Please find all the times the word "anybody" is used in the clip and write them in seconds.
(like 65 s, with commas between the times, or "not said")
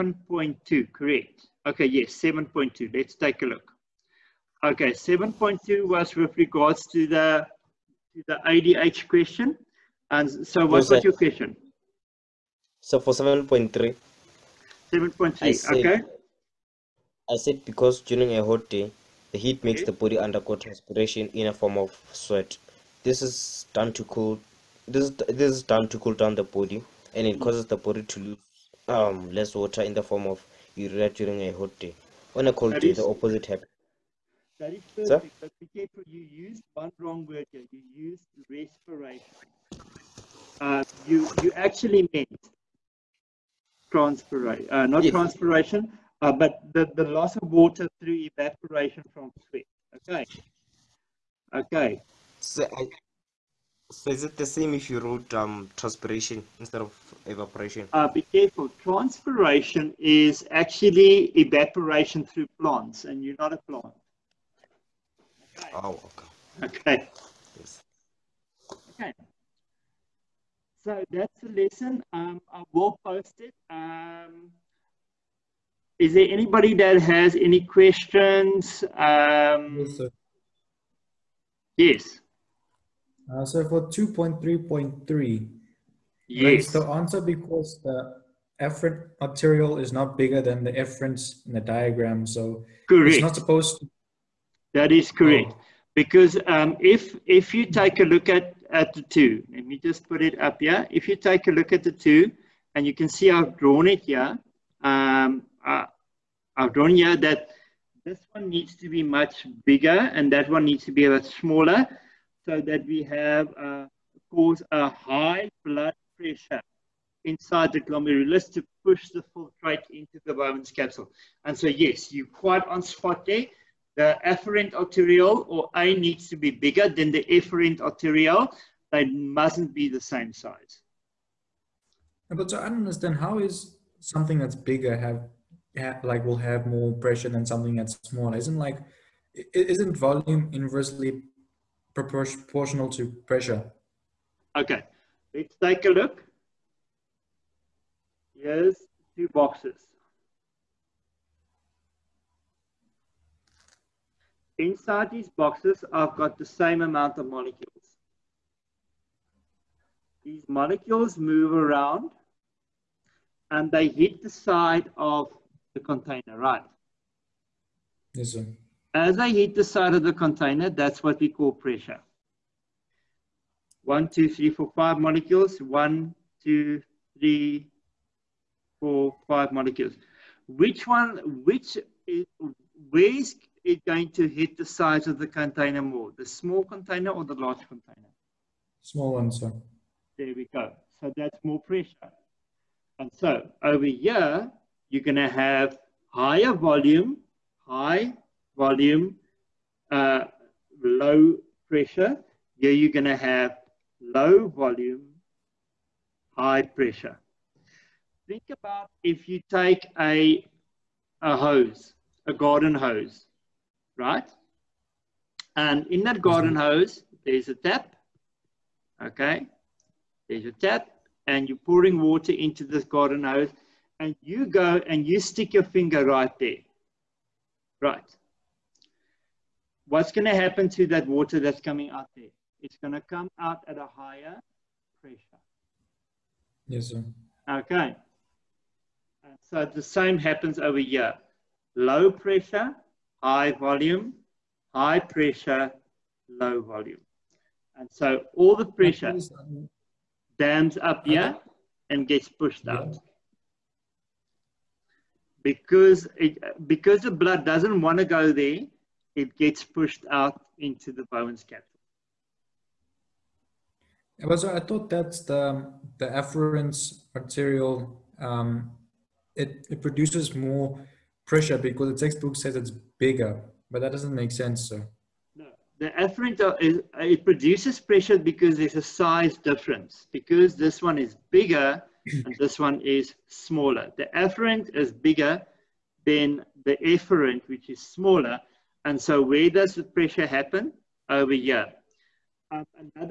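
76 s.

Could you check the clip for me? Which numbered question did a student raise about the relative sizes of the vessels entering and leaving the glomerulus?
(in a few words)
2.3.3.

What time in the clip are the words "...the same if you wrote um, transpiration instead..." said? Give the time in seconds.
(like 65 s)
54 s.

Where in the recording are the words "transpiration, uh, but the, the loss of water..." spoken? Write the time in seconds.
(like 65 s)
45 s.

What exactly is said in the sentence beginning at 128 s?
They mustn't be the same size.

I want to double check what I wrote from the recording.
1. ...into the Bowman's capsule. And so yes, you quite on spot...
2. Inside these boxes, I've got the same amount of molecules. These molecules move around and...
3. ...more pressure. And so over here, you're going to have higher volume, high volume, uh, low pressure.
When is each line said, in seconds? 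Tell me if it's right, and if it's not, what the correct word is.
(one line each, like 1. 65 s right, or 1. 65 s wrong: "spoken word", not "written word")
1. 119 s right
2. 154 s right
3. 191 s right.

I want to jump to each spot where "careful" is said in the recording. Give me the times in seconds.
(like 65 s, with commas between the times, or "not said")
35 s, 58 s.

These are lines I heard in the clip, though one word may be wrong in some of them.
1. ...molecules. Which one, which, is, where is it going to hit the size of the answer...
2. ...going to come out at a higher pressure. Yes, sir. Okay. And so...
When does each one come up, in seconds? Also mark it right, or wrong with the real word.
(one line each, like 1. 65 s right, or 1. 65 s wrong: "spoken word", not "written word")
1. 179 s wrong: "container", not "answer"
2. 232 s right.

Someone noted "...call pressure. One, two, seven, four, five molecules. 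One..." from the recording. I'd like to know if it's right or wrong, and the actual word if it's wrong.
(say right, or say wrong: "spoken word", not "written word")
wrong: "three", not "seven".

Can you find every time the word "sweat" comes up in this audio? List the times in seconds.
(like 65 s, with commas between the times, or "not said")
22 s, 49 s.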